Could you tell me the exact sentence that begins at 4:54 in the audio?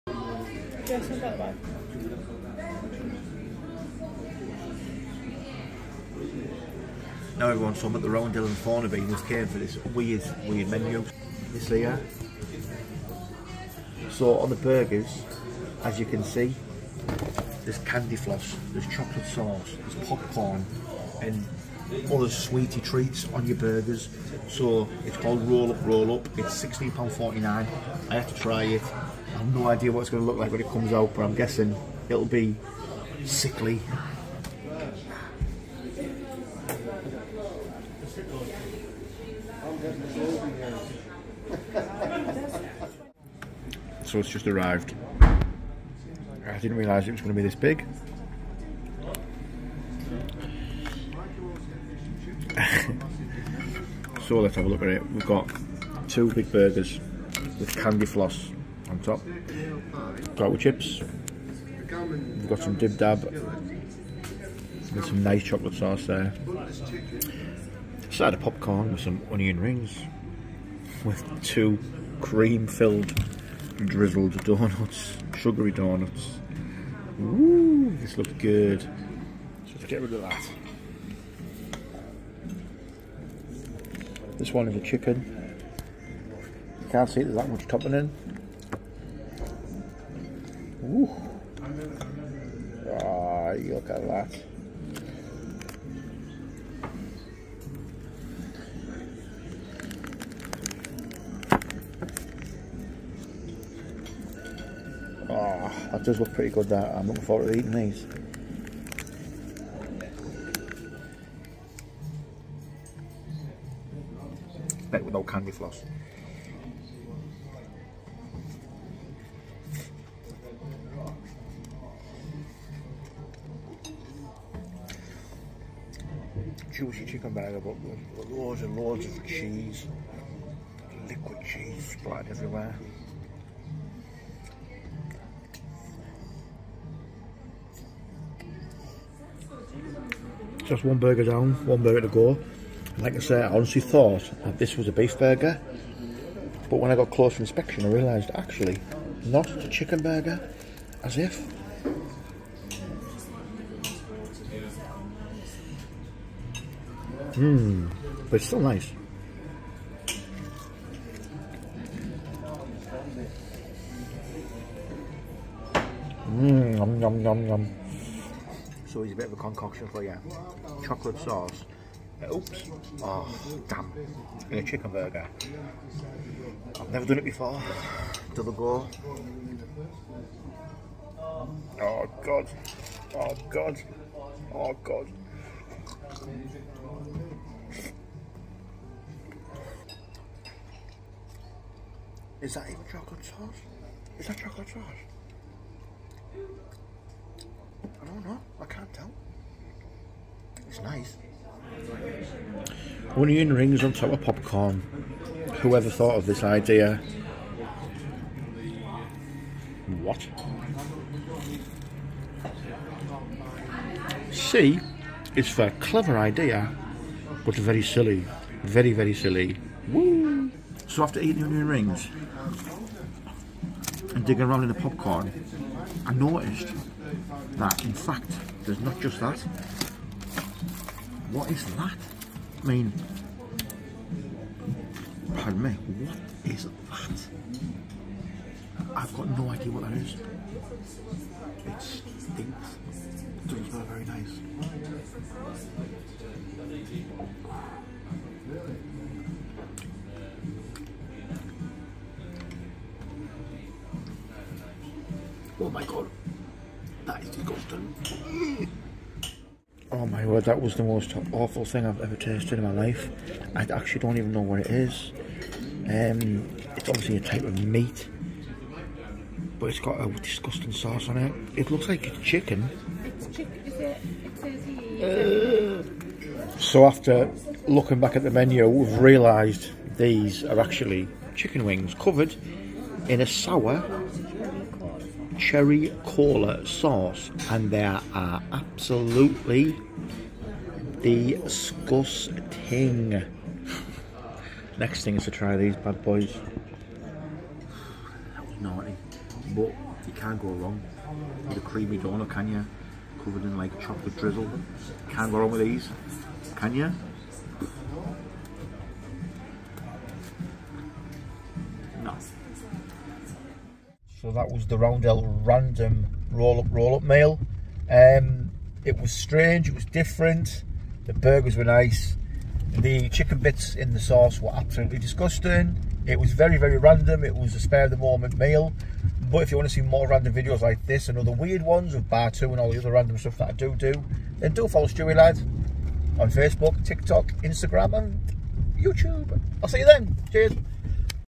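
Next thing is to try these bad boys.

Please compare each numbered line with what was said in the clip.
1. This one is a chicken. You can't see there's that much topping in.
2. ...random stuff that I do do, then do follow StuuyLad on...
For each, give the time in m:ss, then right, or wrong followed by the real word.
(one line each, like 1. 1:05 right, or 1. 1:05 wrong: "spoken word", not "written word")
1. 1:24 right
2. 5:32 right.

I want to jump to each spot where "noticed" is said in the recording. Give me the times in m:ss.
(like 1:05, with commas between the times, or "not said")
3:46.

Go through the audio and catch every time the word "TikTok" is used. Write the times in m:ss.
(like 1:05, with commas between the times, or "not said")
5:36.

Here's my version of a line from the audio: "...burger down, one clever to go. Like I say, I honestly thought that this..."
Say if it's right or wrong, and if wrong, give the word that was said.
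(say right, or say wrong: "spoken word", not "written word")
wrong: "burger", not "clever".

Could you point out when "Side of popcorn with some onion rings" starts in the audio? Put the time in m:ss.
1:08.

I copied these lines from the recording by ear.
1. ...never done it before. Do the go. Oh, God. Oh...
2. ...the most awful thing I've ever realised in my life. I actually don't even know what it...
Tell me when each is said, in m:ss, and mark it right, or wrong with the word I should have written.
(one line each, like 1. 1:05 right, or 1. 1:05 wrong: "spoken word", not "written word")
1. 2:56 right
2. 4:20 wrong: "tasted", not "realised".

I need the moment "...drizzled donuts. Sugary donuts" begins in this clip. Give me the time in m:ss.
1:13.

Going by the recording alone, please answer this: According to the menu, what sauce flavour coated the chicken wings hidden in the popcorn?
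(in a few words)
sour cherry cola.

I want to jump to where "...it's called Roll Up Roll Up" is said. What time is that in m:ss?
0:25.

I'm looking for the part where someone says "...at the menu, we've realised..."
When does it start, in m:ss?
4:38.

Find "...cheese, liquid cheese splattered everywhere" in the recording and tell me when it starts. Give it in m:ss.
2:09.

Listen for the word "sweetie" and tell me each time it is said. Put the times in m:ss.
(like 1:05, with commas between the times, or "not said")
0:22.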